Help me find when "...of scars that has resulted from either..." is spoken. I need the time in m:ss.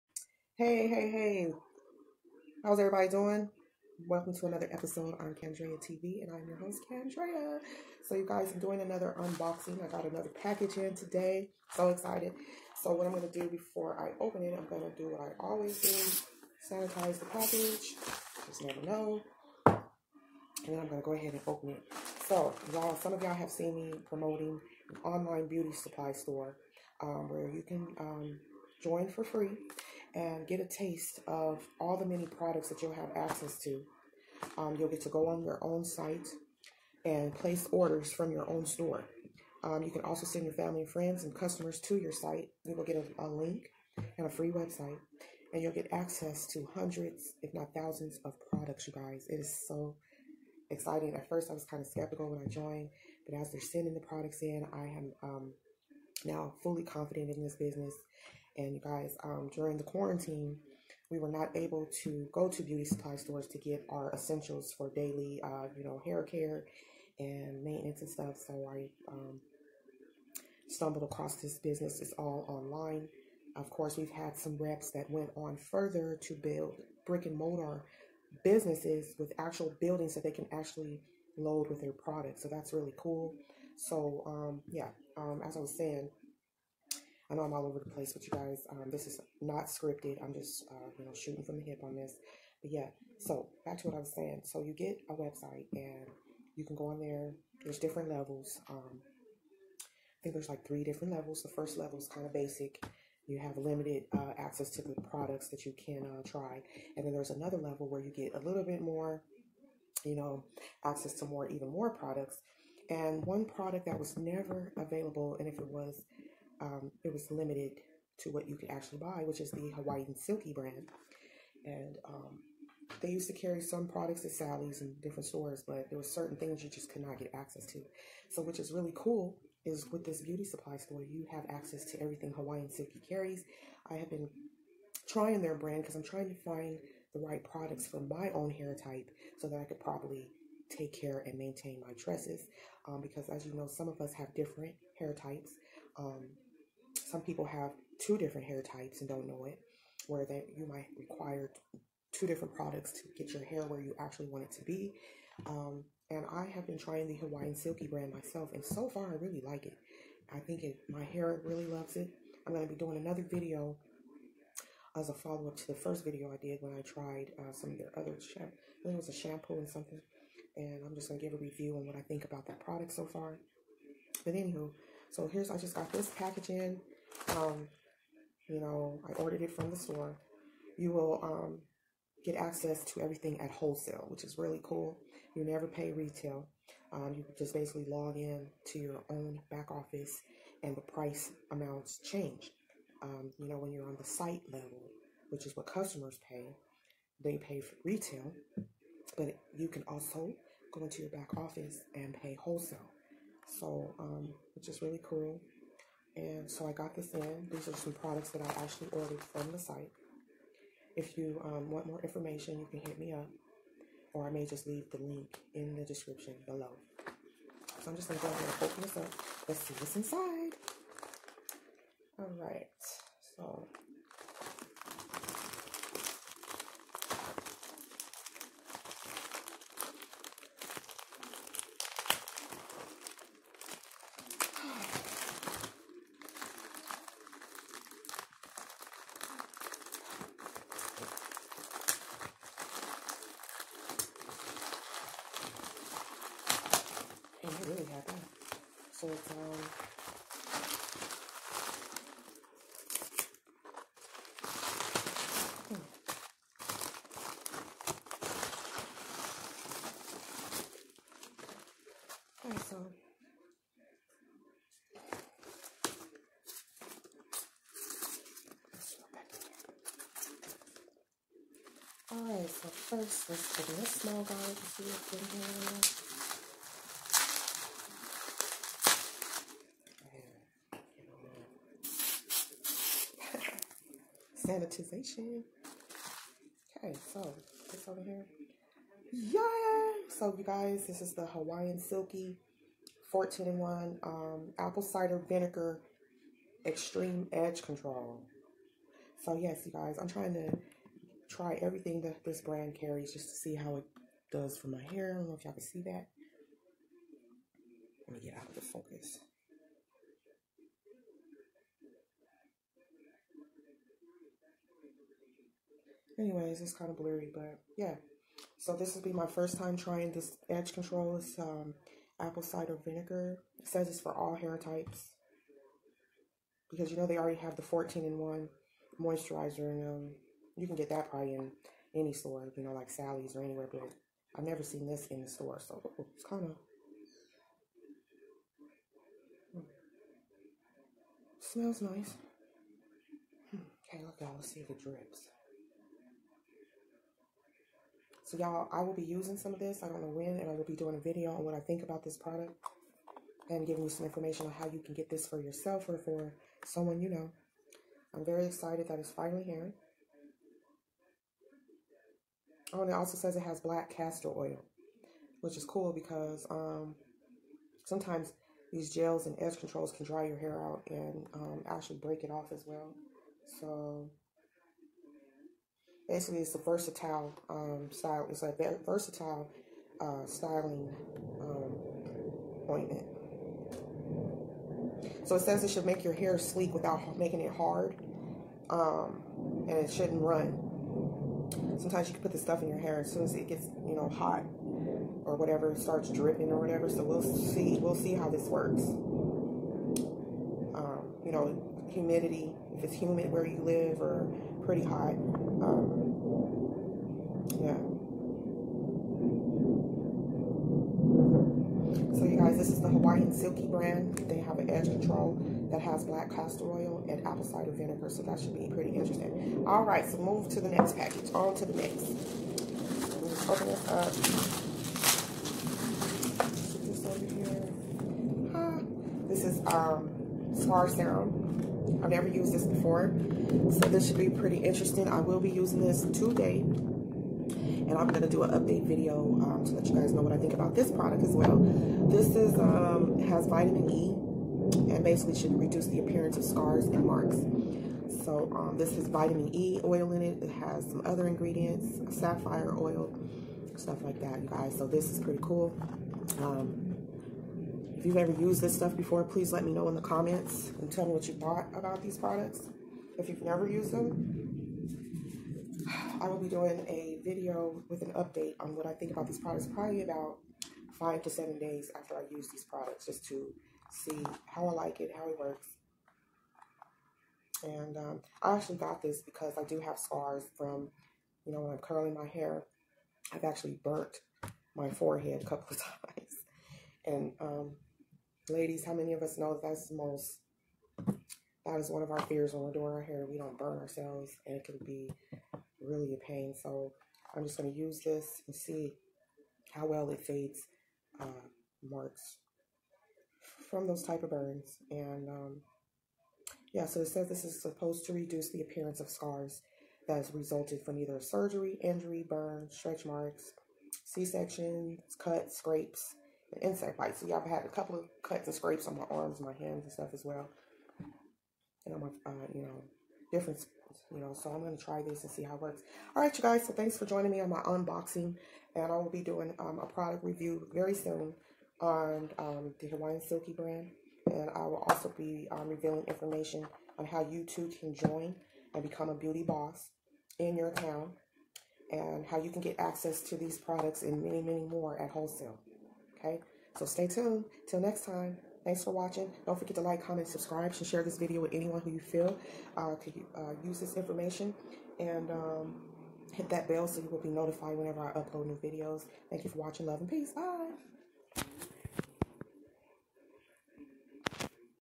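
8:28.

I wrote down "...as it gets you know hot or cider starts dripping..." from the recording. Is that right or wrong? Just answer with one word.
wrong.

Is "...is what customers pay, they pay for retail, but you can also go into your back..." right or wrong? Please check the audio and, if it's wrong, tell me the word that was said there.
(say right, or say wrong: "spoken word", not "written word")
right.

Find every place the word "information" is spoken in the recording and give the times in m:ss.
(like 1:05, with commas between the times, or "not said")
3:32, 5:54, 8:56, 9:13.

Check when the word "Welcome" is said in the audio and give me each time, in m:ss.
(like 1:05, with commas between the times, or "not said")
0:04.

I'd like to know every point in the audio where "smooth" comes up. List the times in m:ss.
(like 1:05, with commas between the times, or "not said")
not said.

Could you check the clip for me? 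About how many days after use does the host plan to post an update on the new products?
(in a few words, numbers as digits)
5 to 7.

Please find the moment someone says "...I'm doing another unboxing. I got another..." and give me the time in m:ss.
0:08.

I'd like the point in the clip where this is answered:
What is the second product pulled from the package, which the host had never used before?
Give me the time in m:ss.
7:10.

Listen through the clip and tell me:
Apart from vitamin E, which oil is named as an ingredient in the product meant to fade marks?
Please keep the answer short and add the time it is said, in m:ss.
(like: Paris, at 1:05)
Safflower oil, at 7:32.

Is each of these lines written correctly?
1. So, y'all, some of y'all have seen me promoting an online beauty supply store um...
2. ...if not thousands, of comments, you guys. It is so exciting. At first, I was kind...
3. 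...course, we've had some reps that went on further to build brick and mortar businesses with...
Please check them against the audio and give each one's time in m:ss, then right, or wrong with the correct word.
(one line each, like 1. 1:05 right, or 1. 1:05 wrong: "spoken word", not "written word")
1. 0:22 right
2. 0:47 wrong: "products", not "comments"
3. 1:13 right.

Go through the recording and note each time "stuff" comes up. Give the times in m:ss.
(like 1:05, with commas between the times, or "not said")
1:08, 6:32, 7:33, 7:38, 8:39.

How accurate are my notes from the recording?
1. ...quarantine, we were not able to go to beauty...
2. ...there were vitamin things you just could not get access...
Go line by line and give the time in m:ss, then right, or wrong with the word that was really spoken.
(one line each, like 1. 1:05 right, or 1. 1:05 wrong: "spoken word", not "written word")
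1. 0:59 right
2. 2:05 wrong: "certain", not "vitamin".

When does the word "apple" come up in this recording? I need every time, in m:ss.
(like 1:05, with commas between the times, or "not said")
4:54, 5:22, 6:57.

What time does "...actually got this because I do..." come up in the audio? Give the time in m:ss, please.
7:58.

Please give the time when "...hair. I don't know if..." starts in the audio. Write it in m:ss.
5:04.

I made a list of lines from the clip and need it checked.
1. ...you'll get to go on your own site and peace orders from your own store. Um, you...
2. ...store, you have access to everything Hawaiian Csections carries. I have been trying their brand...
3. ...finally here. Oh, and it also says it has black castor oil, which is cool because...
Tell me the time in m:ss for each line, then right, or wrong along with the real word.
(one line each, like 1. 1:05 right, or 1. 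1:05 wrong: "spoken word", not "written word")
1. 0:34 wrong: "place", not "peace"
2. 2:10 wrong: "Silky", not "Csections"
3. 5:59 right.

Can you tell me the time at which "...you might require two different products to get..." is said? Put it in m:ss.
2:30.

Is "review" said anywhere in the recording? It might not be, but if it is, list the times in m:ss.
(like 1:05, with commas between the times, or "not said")
2:51, 8:50.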